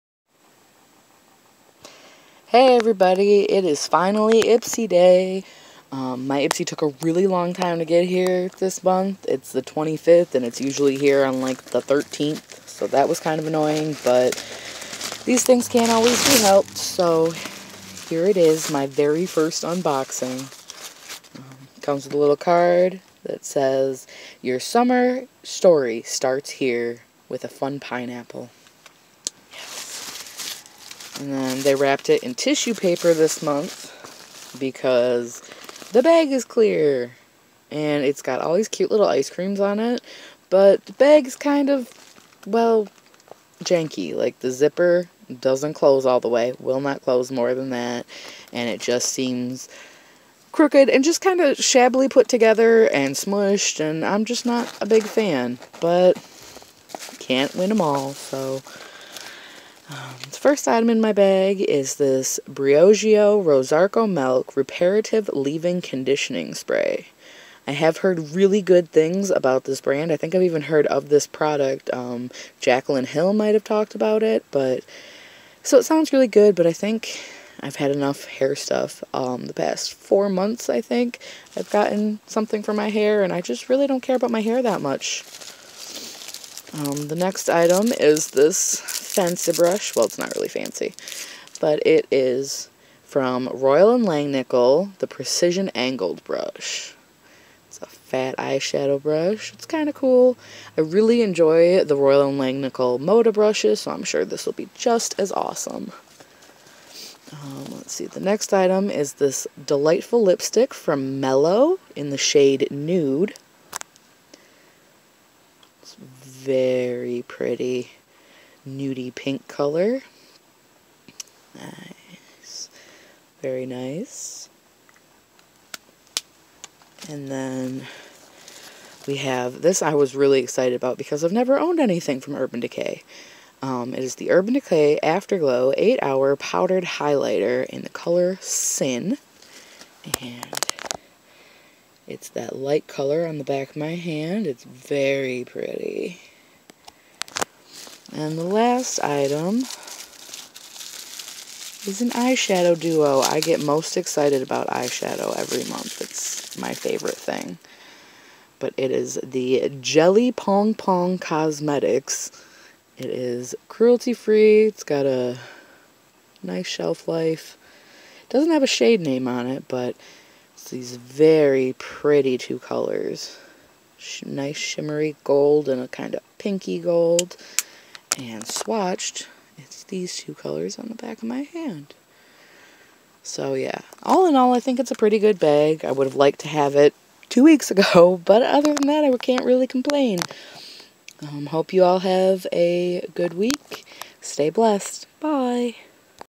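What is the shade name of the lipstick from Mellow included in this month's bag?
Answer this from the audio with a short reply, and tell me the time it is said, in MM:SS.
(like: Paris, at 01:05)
Nude, at 01:52.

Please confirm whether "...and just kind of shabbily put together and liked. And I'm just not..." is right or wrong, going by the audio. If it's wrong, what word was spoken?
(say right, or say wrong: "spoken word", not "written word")
wrong: "smushed", not "liked".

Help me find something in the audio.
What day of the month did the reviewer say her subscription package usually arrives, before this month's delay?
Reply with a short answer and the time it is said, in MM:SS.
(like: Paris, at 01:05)
13th, at 00:11.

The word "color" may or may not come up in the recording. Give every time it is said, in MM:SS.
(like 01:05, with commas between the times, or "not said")
01:59, 02:17, 02:22, 02:52, 03:00.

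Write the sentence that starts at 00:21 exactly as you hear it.
Um, comes with a little card that says, Your summer story starts here with a fun pineapple.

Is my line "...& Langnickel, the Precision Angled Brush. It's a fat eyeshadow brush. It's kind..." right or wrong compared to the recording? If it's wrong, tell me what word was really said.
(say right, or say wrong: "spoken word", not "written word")
right.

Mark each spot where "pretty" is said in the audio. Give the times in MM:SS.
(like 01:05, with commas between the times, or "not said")
01:57, 02:25, 02:51, 03:04.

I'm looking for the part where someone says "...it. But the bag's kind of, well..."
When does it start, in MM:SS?
00:39.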